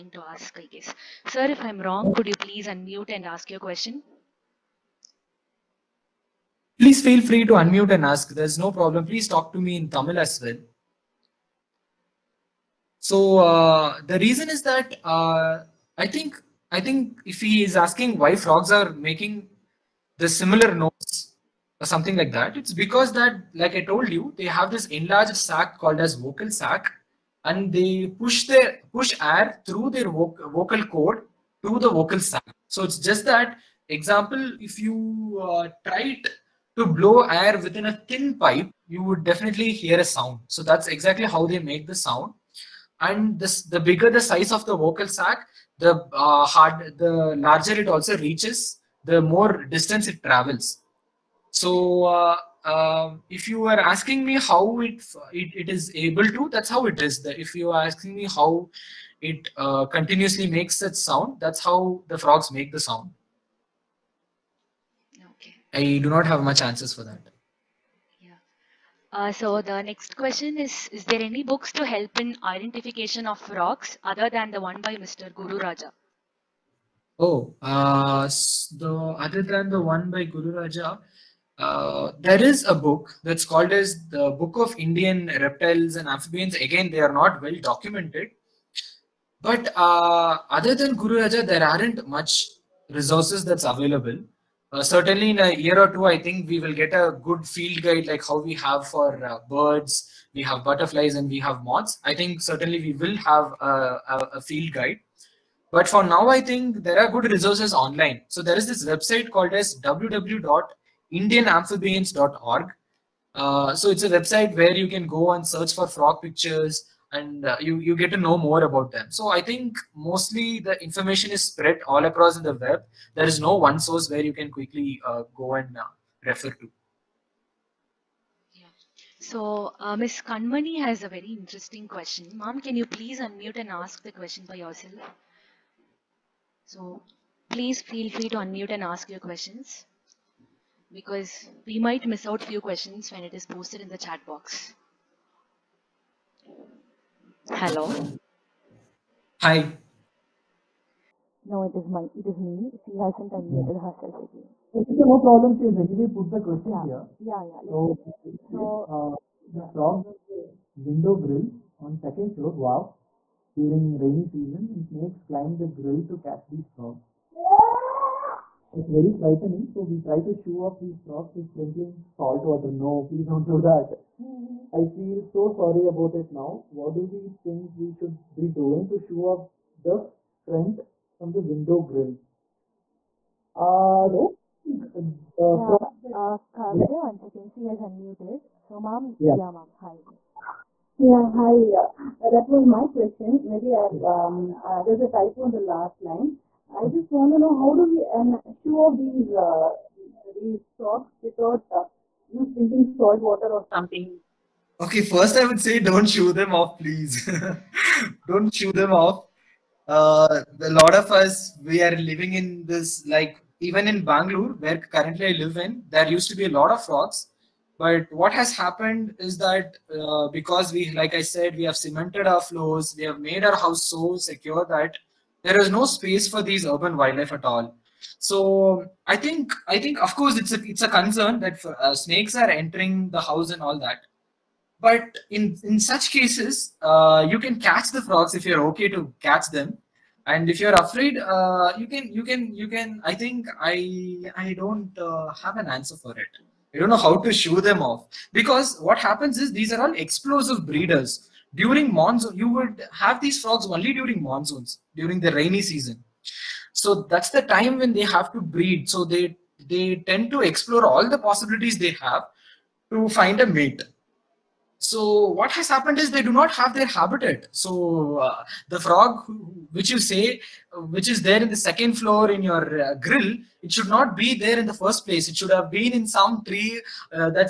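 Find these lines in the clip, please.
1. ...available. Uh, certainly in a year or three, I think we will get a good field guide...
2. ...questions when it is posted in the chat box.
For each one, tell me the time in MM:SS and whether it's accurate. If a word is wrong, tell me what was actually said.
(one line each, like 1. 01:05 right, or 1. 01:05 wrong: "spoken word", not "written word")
1. 01:33 wrong: "two", not "three"
2. 02:22 right.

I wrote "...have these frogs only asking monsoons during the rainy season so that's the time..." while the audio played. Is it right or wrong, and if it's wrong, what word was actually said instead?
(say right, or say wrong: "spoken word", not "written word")
wrong: "during", not "asking".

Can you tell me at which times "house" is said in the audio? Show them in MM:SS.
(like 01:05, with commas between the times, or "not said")
03:43, 03:53.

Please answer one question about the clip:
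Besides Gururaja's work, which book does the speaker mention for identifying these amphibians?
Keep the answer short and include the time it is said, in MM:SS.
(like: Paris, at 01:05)
Book of Indian Reptiles and Amphibians, at 01:24.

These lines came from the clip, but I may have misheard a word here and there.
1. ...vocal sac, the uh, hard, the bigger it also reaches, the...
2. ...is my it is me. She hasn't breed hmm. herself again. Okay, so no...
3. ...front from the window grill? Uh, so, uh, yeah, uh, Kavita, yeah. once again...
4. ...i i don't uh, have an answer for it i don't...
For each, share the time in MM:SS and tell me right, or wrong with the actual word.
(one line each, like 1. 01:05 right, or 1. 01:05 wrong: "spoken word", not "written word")
1. 00:44 wrong: "larger", not "bigger"
2. 02:31 wrong: "unmuted", not "breed"
3. 03:00 right
4. 04:03 right.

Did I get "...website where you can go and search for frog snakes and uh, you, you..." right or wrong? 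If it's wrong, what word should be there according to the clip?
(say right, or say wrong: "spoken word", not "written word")
wrong: "pictures", not "snakes".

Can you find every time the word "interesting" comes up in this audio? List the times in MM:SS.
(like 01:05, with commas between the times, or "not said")
02:11.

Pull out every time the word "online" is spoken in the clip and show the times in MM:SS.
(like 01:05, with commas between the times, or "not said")
01:47.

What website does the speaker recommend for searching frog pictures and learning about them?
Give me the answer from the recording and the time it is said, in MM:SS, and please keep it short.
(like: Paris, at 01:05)
www.indianamphibians.org, at 01:49.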